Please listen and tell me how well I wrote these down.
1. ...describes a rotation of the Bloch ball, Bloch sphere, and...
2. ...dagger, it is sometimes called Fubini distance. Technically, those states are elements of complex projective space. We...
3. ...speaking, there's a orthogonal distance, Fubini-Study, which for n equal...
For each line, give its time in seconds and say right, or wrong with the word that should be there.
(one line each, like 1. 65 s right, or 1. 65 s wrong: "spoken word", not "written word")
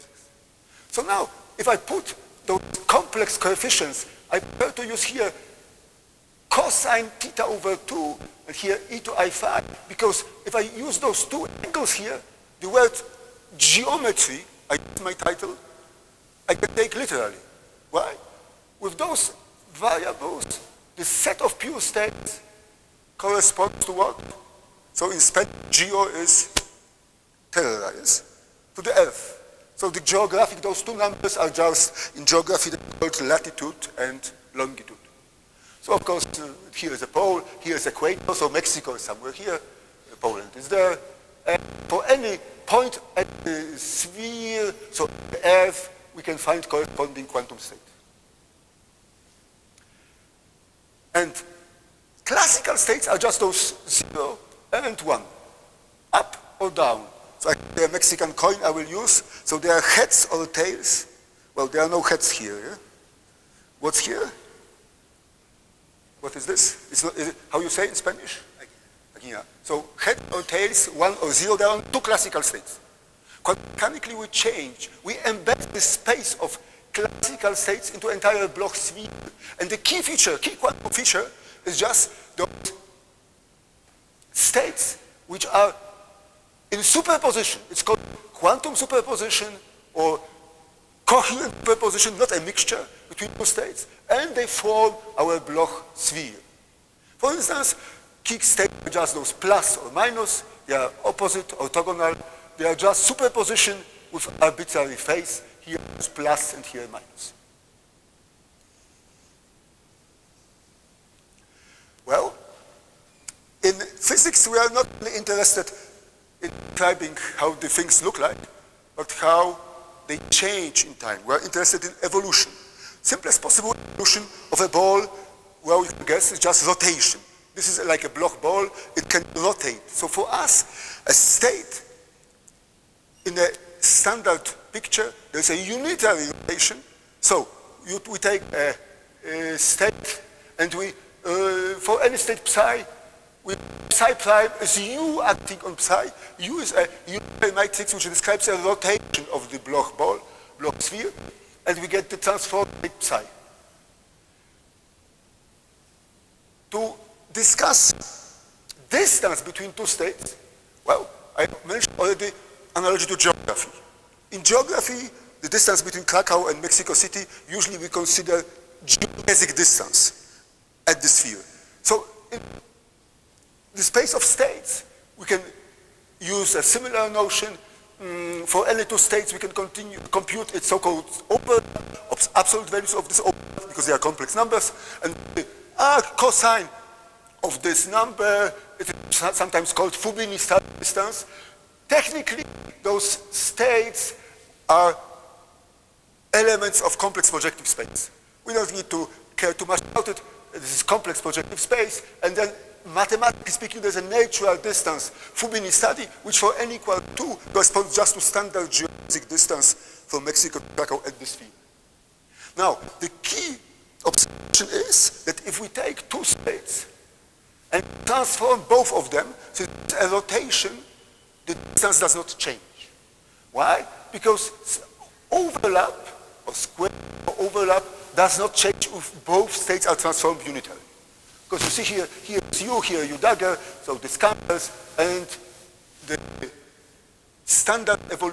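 1. 148 s right
2. 187 s wrong: "number", not "dagger"
3. 203 s wrong: "natural", not "orthogonal".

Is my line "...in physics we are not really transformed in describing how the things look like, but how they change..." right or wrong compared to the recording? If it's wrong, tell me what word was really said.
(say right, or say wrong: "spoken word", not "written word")
wrong: "interested", not "transformed".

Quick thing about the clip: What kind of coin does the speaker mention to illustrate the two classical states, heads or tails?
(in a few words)
Mexican coin.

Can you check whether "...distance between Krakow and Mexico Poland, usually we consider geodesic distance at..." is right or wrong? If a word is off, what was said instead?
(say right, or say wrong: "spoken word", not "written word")
wrong: "City", not "Poland".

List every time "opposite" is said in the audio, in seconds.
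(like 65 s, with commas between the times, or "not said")
101 s.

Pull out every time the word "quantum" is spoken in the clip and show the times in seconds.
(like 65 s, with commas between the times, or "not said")
47 s, 80 s, 88 s.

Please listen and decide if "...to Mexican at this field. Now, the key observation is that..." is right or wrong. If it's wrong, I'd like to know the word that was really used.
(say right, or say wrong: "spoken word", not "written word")
wrong: "Krakow", not "Mexican".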